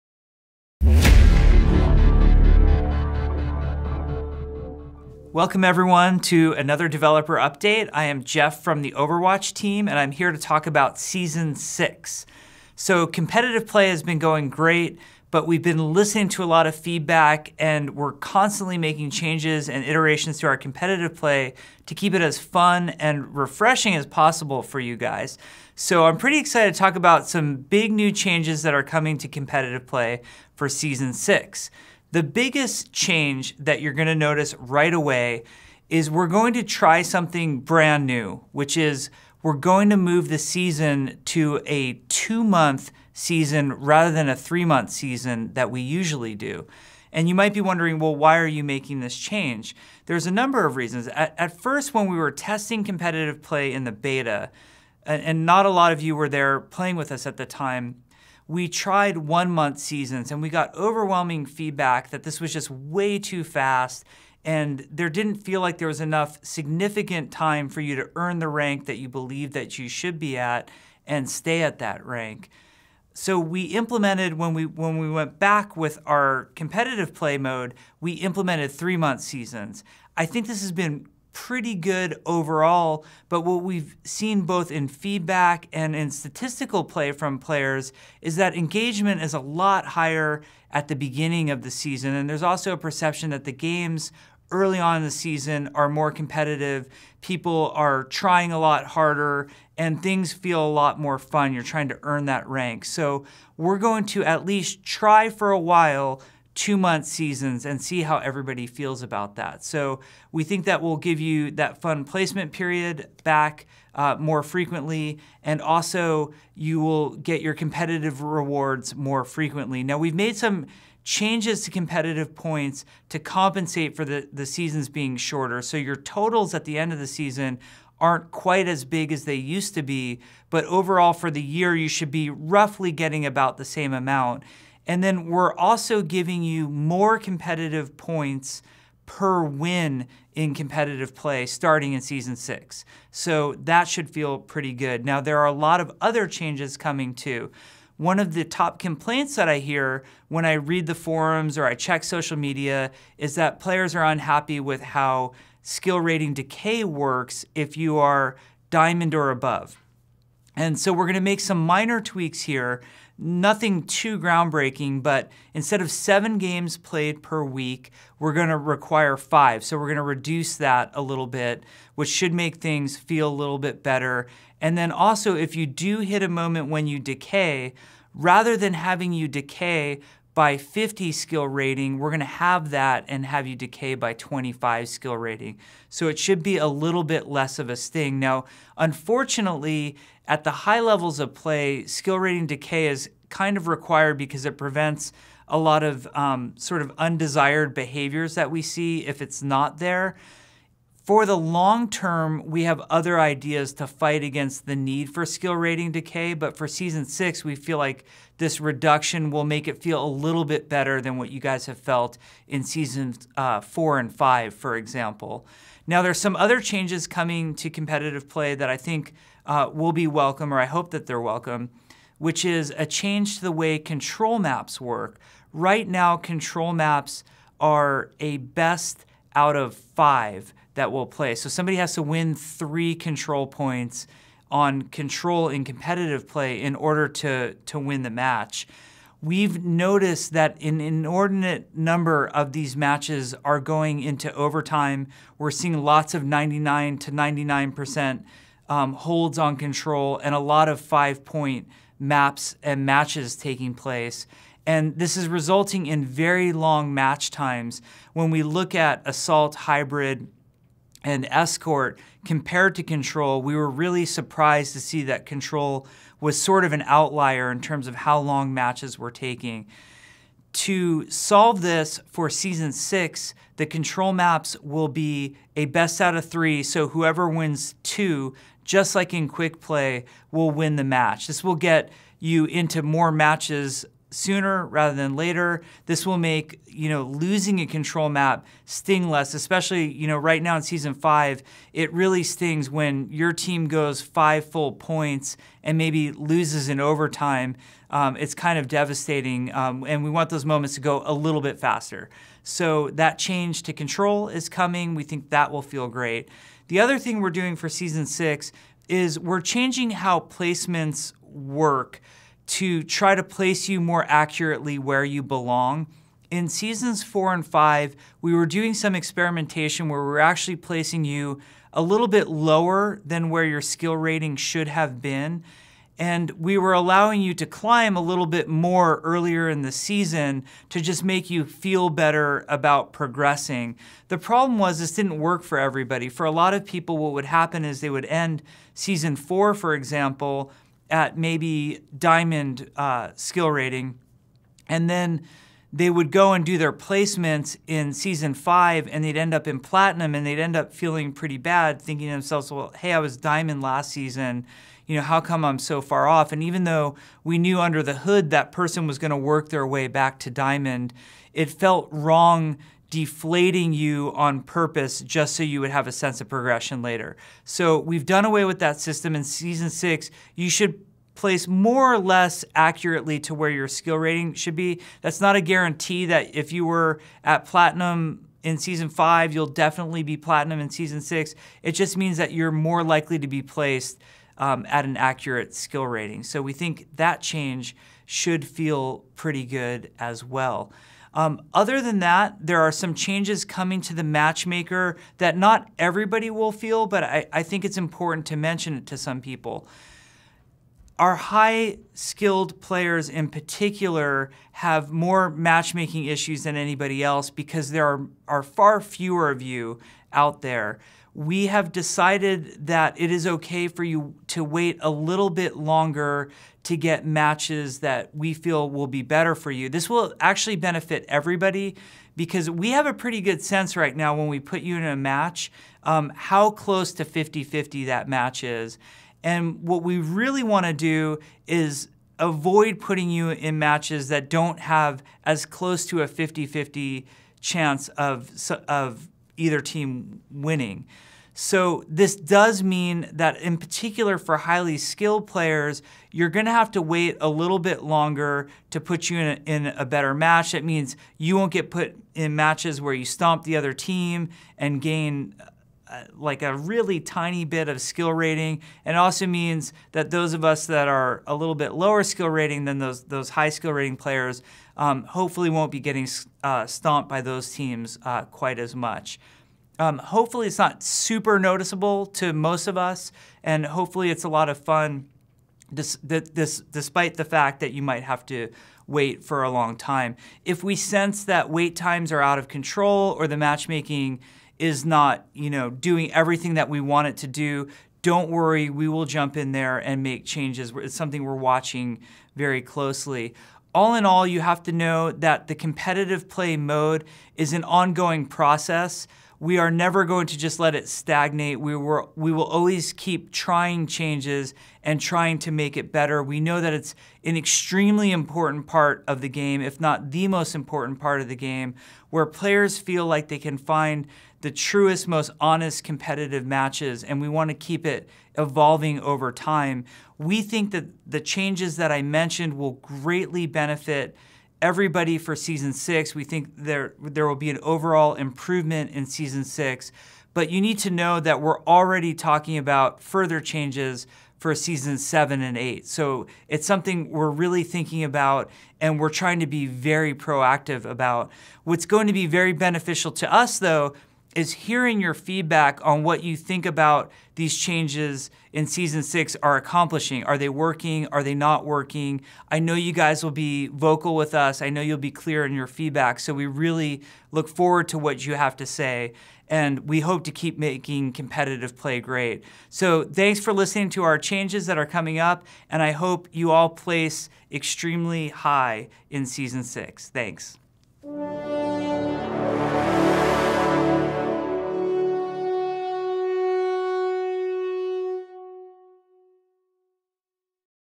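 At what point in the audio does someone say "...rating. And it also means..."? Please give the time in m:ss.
7:38.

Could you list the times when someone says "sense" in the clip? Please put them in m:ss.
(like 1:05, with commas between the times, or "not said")
6:05, 7:03, 8:00.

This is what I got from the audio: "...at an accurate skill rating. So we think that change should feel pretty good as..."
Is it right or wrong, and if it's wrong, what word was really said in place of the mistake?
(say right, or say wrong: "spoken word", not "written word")
right.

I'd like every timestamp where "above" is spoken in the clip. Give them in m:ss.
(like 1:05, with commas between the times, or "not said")
2:39.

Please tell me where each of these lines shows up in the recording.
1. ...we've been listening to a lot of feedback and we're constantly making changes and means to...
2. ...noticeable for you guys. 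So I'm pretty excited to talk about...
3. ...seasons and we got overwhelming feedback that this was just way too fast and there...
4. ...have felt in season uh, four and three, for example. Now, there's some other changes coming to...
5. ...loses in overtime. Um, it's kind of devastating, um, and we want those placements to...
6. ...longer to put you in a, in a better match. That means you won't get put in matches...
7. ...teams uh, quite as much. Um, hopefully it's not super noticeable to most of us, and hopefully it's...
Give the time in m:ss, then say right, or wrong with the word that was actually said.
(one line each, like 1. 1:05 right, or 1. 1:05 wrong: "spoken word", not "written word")
1. 0:15 wrong: "iterations", not "means"
2. 0:24 wrong: "possible", not "noticeable"
3. 0:59 right
4. 3:31 wrong: "five", not "three"
5. 4:56 wrong: "moments", not "placements"
6. 7:27 right
7. 7:47 right.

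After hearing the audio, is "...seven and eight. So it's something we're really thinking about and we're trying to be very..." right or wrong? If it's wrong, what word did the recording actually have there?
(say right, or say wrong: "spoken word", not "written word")
right.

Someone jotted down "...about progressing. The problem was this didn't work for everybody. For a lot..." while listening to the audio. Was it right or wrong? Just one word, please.
right.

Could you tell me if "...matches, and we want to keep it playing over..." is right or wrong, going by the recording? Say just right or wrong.
wrong.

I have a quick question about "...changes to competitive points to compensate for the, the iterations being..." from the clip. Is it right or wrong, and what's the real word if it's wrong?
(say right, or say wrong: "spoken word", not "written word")
wrong: "seasons", not "iterations".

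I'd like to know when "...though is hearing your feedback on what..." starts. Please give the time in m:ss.
9:03.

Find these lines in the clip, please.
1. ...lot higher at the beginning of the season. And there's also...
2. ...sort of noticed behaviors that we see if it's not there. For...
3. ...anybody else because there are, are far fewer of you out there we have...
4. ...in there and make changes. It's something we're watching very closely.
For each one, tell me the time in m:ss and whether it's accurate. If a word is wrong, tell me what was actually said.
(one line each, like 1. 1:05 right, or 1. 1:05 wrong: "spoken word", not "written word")
1. 1:29 right
2. 3:16 wrong: "undesired", not "noticed"
3. 6:46 right
4. 8:09 right.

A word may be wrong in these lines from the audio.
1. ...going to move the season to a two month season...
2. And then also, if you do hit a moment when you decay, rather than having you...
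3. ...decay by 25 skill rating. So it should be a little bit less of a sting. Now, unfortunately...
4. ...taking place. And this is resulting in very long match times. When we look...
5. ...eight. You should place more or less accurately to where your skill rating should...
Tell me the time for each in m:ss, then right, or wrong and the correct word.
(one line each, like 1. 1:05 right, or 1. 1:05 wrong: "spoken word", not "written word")
1. 0:39 right
2. 2:54 right
3. 3:03 right
4. 4:13 right
5. 6:09 wrong: "six", not "eight".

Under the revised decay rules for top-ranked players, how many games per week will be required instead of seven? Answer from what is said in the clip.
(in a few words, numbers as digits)
5.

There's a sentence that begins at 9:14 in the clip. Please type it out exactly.
I know you'll be clear in your feedback.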